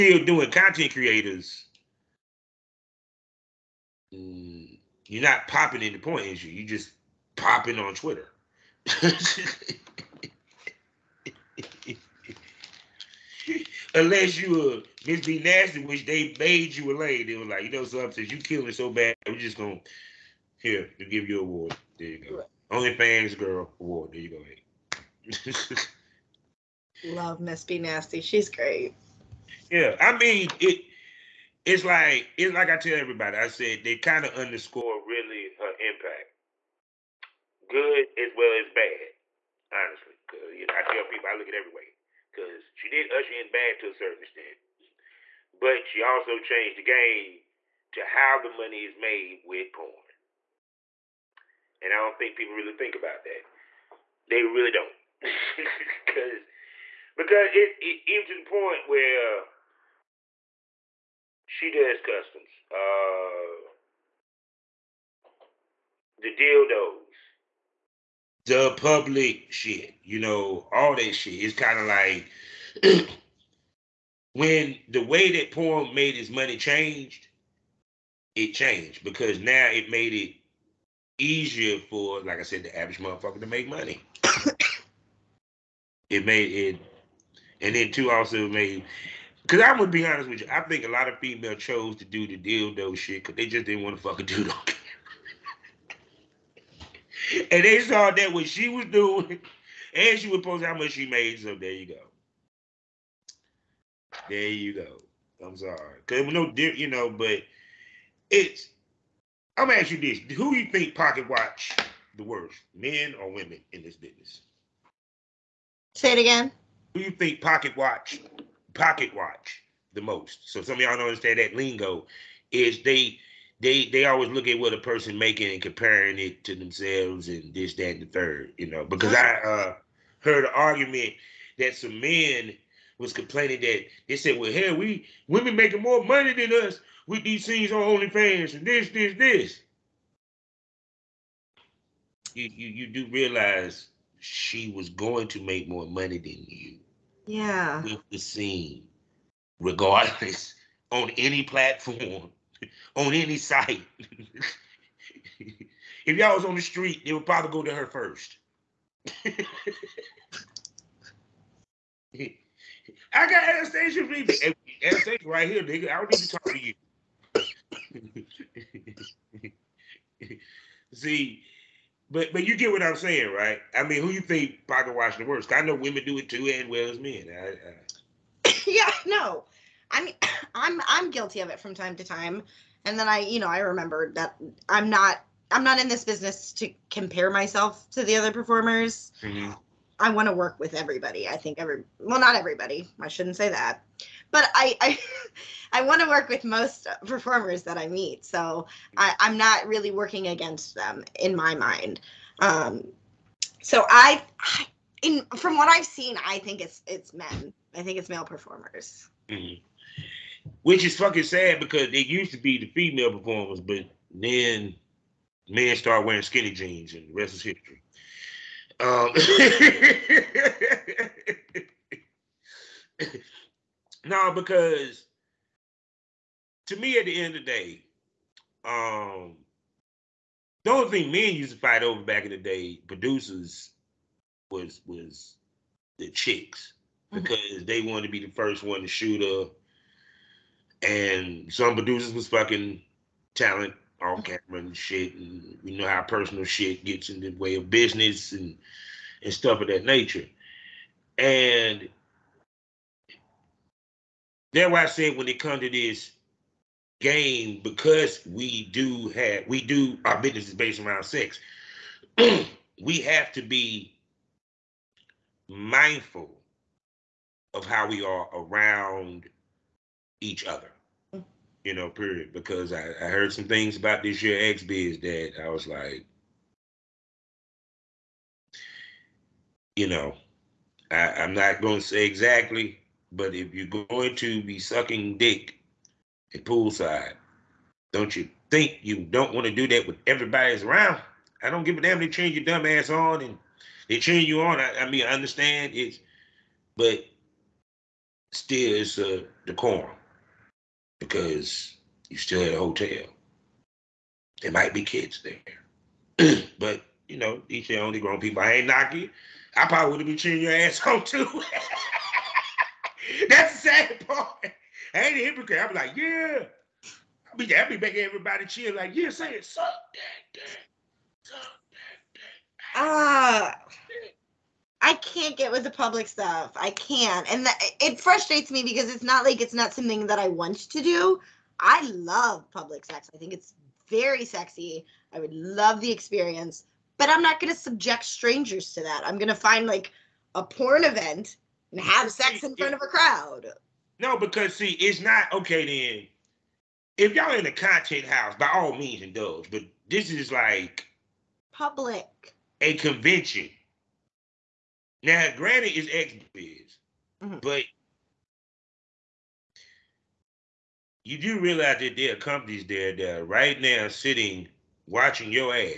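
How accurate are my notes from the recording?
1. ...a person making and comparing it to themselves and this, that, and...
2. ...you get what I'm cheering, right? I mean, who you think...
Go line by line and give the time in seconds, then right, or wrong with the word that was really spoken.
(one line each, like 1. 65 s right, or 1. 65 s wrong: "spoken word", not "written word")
1. 124 s right
2. 172 s wrong: "saying", not "cheering".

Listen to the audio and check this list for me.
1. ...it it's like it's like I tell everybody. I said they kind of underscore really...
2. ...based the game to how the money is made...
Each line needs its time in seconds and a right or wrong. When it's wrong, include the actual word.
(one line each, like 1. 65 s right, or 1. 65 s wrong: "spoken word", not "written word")
1. 30 s right
2. 46 s wrong: "changed", not "based".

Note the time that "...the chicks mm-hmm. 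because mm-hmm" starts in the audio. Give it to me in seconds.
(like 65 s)
235 s.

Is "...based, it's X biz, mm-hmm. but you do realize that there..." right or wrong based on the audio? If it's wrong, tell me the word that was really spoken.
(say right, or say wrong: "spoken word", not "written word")
wrong: "granted", not "based".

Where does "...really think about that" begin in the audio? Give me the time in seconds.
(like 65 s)
52 s.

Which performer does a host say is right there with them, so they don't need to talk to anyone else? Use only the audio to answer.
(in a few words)
Anastasia Vivi.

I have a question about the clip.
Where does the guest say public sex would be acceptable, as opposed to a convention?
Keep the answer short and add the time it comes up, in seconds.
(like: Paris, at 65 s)
content house, at 347 s.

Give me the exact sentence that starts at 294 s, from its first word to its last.
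I, I mean, I understand it's, but still it's a decorum because you still at a hotel.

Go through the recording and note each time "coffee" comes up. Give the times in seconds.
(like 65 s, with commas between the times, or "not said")
not said.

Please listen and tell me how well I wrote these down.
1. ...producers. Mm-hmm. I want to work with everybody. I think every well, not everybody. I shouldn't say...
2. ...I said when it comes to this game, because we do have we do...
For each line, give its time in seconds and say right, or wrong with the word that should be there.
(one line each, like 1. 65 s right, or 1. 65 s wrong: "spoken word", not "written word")
1. 188 s wrong: "performers", not "producers"
2. 254 s right.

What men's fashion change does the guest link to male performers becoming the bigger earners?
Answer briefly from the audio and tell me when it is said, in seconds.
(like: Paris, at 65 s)
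skinny jeans, at 216 s.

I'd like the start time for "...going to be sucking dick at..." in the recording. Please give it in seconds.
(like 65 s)
283 s.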